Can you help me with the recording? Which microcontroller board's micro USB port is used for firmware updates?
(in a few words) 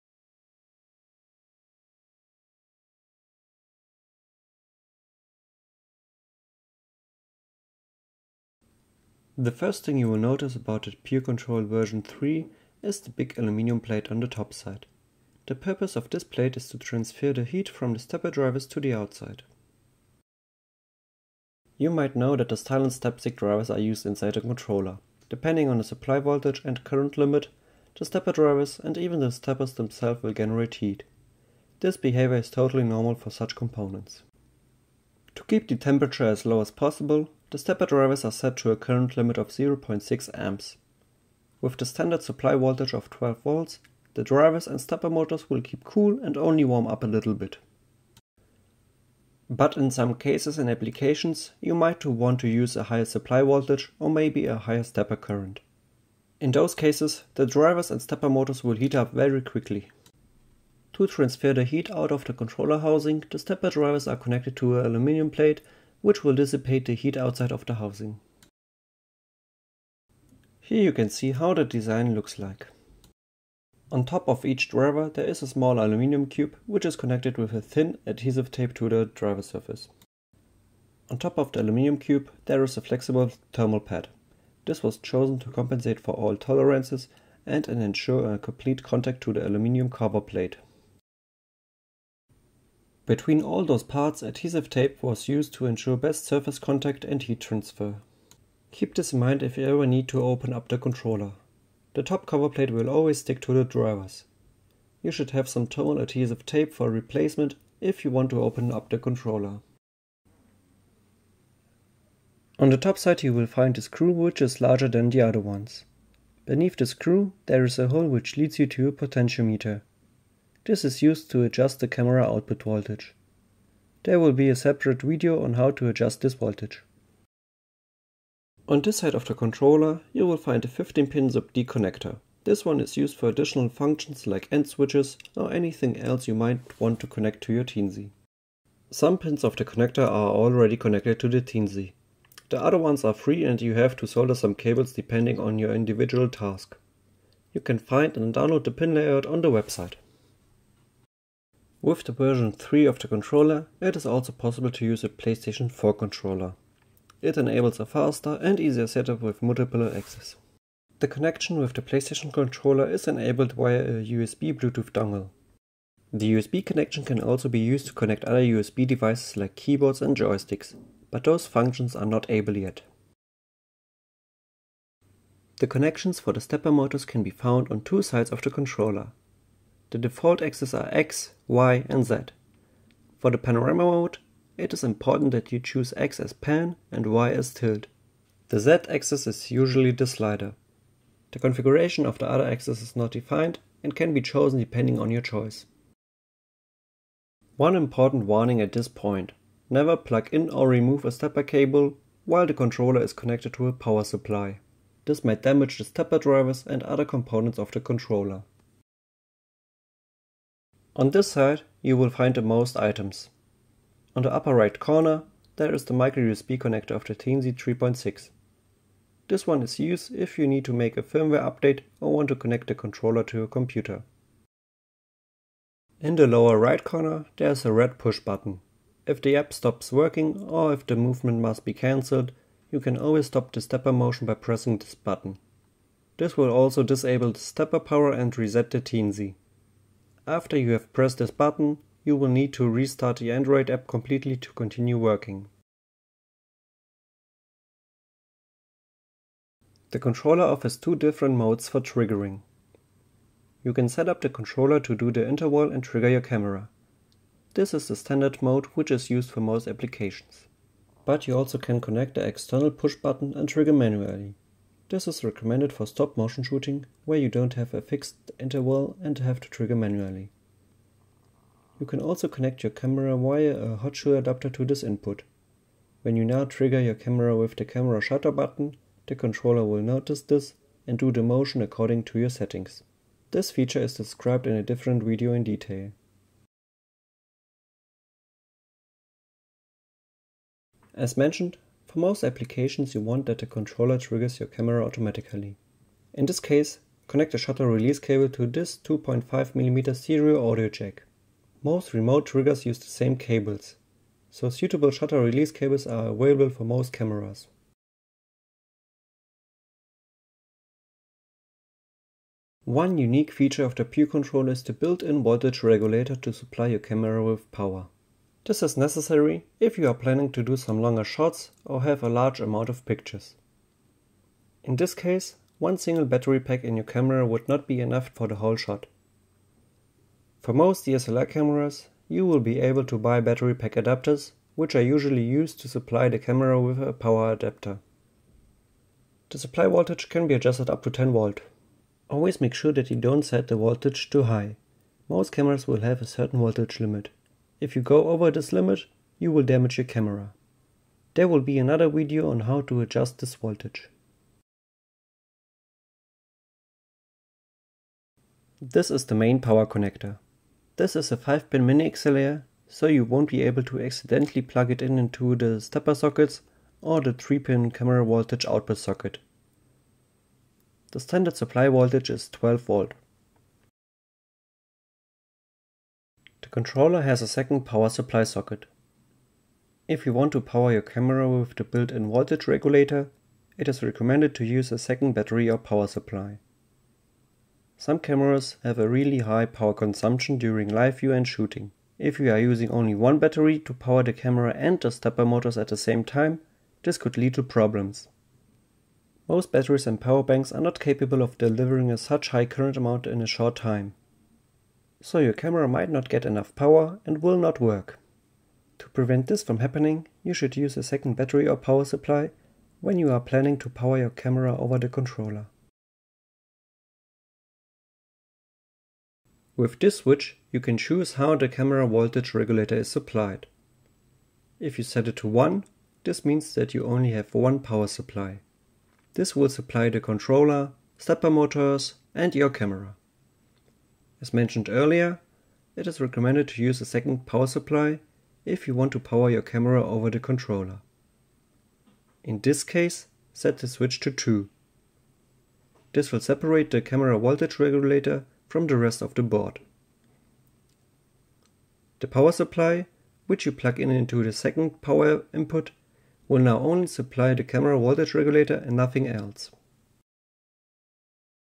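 Teensy 3.6.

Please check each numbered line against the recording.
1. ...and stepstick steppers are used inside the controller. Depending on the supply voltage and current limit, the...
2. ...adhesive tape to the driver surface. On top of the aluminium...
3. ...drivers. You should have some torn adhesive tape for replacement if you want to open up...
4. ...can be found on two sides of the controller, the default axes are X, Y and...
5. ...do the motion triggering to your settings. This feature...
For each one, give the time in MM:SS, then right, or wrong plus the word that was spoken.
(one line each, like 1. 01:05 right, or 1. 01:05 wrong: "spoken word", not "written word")
1. 00:23 wrong: "drivers", not "steppers"
2. 01:18 right
3. 01:43 right
4. 02:57 right
5. 04:40 wrong: "according", not "triggering".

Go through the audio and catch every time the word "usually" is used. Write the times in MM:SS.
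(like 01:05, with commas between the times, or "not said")
03:09, 05:34.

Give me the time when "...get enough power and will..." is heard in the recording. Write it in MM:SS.
06:46.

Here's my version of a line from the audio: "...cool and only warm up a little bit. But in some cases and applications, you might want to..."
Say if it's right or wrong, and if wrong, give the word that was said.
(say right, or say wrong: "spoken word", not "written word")
right.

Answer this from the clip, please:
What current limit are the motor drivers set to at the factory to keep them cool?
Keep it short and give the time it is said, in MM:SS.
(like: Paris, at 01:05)
0.6 amps, at 00:39.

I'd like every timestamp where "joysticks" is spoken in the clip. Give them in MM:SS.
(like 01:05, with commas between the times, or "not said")
02:50.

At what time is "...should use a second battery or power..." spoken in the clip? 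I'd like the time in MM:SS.
06:50.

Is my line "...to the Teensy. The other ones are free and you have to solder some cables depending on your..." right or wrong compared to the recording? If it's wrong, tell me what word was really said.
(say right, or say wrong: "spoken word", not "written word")
right.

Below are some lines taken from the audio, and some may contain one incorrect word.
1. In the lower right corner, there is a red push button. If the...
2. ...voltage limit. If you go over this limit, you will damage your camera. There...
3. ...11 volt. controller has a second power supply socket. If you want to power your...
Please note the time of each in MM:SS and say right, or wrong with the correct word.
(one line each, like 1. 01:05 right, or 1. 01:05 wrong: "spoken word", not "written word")
1. 03:46 right
2. 05:46 right
3. 06:12 wrong: "12", not "11".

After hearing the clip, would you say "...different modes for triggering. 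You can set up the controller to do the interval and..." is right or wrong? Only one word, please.
right.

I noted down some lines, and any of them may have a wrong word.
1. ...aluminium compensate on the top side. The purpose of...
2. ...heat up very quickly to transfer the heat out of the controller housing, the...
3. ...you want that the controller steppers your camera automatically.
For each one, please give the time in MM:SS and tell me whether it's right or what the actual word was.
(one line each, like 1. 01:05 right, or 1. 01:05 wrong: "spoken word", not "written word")
1. 00:13 wrong: "plate", not "compensate"
2. 00:58 right
3. 04:52 wrong: "triggers", not "steppers".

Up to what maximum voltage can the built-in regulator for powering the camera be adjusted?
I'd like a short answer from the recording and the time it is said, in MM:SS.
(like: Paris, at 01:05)
10 volts, at 05:40.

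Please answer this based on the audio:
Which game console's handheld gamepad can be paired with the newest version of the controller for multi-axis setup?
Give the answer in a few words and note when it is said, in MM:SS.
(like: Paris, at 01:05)
PlayStation 4, at 02:35.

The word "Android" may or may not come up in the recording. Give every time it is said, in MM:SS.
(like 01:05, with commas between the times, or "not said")
04:03.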